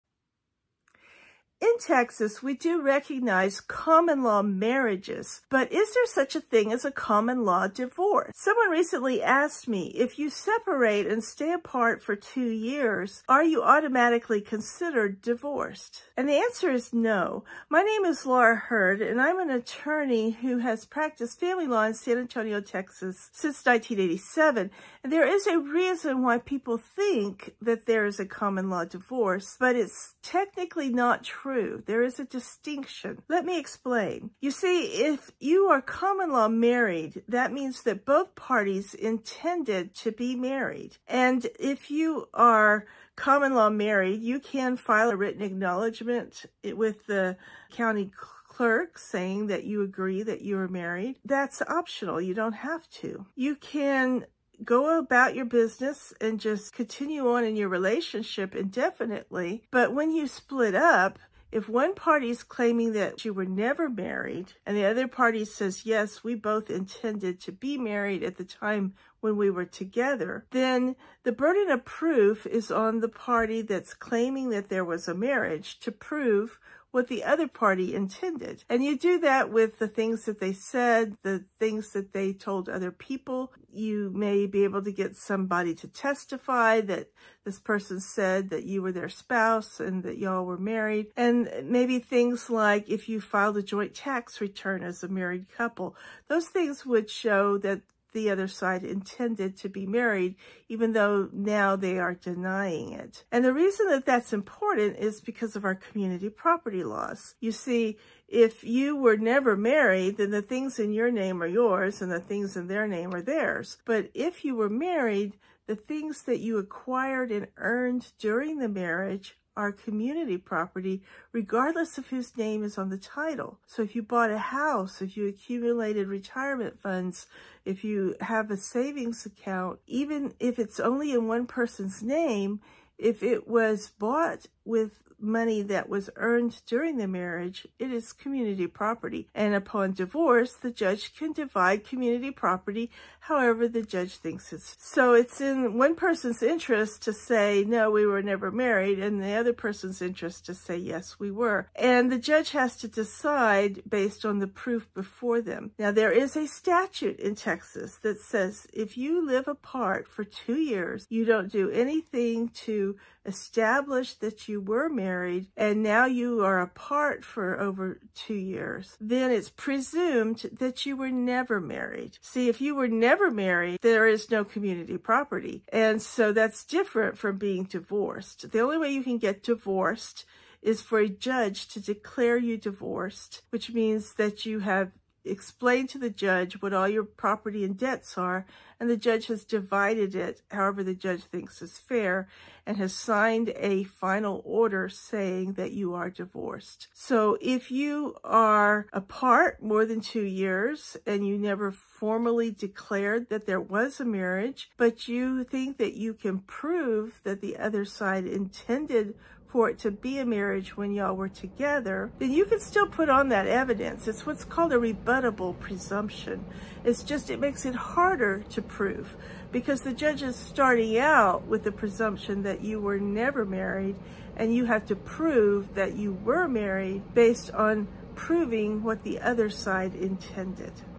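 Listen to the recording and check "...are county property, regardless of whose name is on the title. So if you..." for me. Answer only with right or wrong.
wrong.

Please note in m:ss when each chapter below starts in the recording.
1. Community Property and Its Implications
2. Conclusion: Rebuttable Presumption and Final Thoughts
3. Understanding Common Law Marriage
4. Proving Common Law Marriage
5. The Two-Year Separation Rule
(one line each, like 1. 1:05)
1. 1:43
2. 3:16
3. 0:34
4. 0:53
5. 2:35.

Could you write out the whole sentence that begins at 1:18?
And you do that with the things that they said, the things that they told other people.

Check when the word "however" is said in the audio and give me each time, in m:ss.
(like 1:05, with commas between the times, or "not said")
2:23, 3:10.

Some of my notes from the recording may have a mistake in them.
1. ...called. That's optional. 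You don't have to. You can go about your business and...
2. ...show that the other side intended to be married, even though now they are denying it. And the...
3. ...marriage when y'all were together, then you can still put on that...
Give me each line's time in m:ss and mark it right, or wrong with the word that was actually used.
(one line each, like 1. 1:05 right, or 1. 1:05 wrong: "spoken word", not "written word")
1. 0:50 wrong: "married", not "called"
2. 1:37 right
3. 3:30 right.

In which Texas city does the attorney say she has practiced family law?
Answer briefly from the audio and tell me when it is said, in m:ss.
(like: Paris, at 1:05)
San Antonio, at 0:21.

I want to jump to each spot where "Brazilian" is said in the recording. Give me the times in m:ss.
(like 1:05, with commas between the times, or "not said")
not said.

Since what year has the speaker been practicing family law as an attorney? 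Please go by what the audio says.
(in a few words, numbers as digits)
1987.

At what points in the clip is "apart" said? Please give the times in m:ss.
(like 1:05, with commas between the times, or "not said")
0:11, 2:39, 2:46, 3:18.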